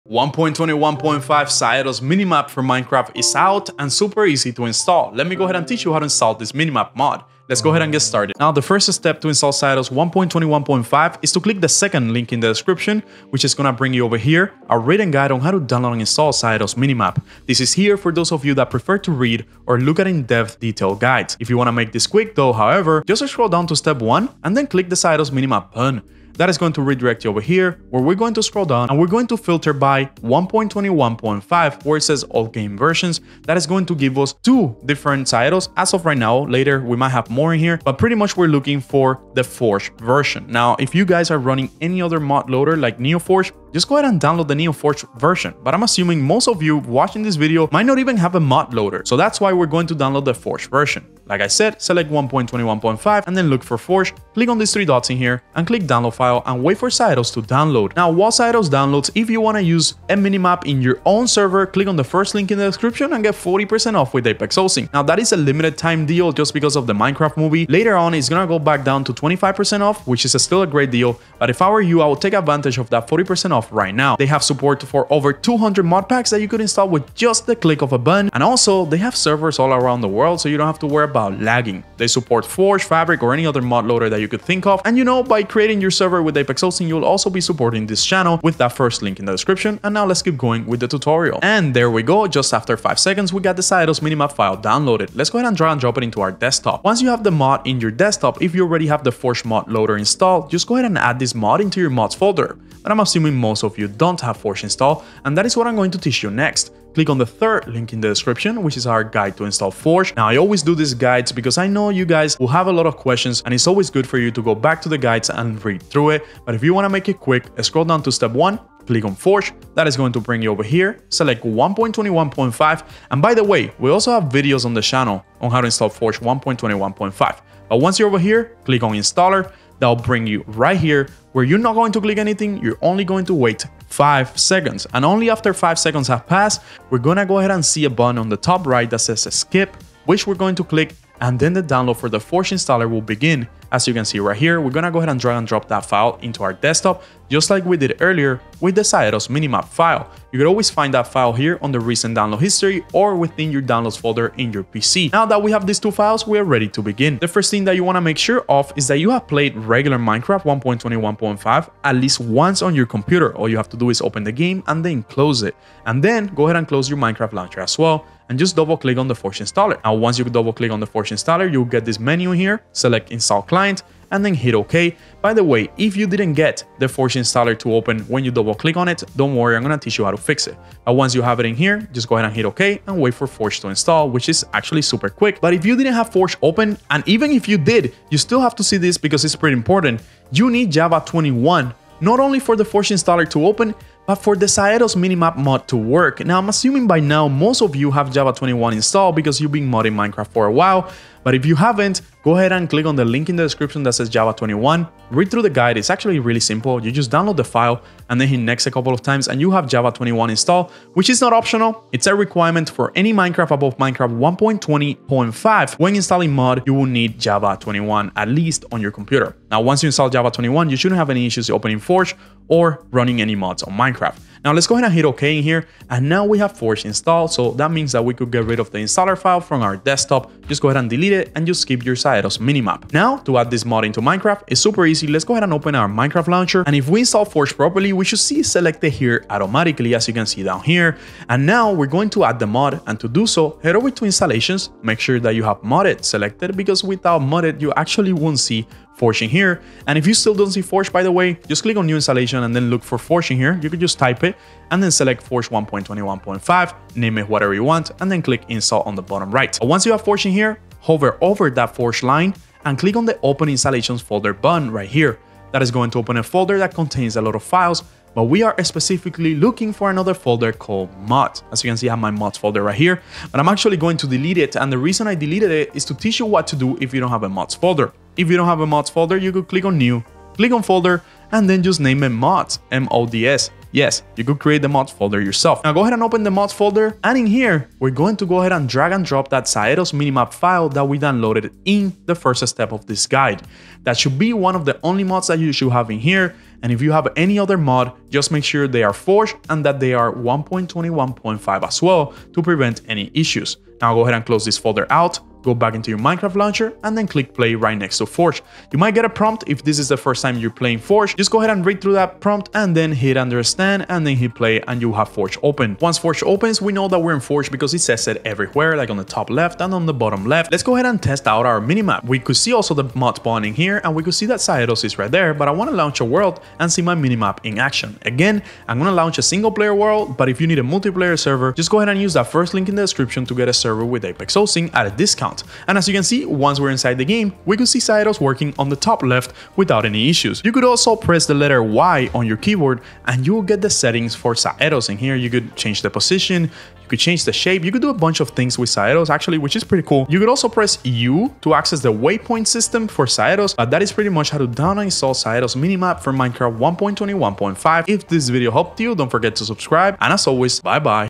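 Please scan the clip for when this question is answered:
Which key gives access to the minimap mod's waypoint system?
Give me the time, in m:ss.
5:50.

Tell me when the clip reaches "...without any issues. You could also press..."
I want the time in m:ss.
5:39.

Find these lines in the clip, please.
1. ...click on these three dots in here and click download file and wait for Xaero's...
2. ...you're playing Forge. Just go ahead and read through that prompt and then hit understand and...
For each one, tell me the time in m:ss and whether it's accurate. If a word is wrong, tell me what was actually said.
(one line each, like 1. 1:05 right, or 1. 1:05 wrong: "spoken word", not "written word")
1. 0:54 right
2. 5:10 right.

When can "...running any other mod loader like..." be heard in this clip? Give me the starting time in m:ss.
0:41.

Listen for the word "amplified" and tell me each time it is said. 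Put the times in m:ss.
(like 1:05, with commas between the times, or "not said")
not said.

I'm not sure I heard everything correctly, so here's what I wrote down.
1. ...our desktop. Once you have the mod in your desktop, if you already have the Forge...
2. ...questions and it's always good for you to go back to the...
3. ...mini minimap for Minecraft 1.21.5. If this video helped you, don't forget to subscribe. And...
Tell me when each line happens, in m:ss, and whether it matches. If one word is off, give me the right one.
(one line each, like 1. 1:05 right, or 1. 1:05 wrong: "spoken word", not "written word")
1. 1:36 right
2. 1:52 right
3. 5:55 right.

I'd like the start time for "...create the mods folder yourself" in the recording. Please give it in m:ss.
4:44.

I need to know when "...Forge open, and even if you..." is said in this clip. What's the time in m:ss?
3:06.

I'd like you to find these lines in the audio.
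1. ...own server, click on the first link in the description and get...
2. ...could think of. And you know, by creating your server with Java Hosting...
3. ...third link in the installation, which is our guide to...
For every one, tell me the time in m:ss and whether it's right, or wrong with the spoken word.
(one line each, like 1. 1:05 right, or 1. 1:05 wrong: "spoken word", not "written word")
1. 1:01 right
2. 1:24 wrong: "Apex", not "Java"
3. 1:47 wrong: "description", not "installation".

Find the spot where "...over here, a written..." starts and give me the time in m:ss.
0:14.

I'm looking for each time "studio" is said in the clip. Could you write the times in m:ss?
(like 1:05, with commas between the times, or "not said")
not said.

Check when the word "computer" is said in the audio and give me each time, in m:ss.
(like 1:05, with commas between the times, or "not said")
2:42, 3:38.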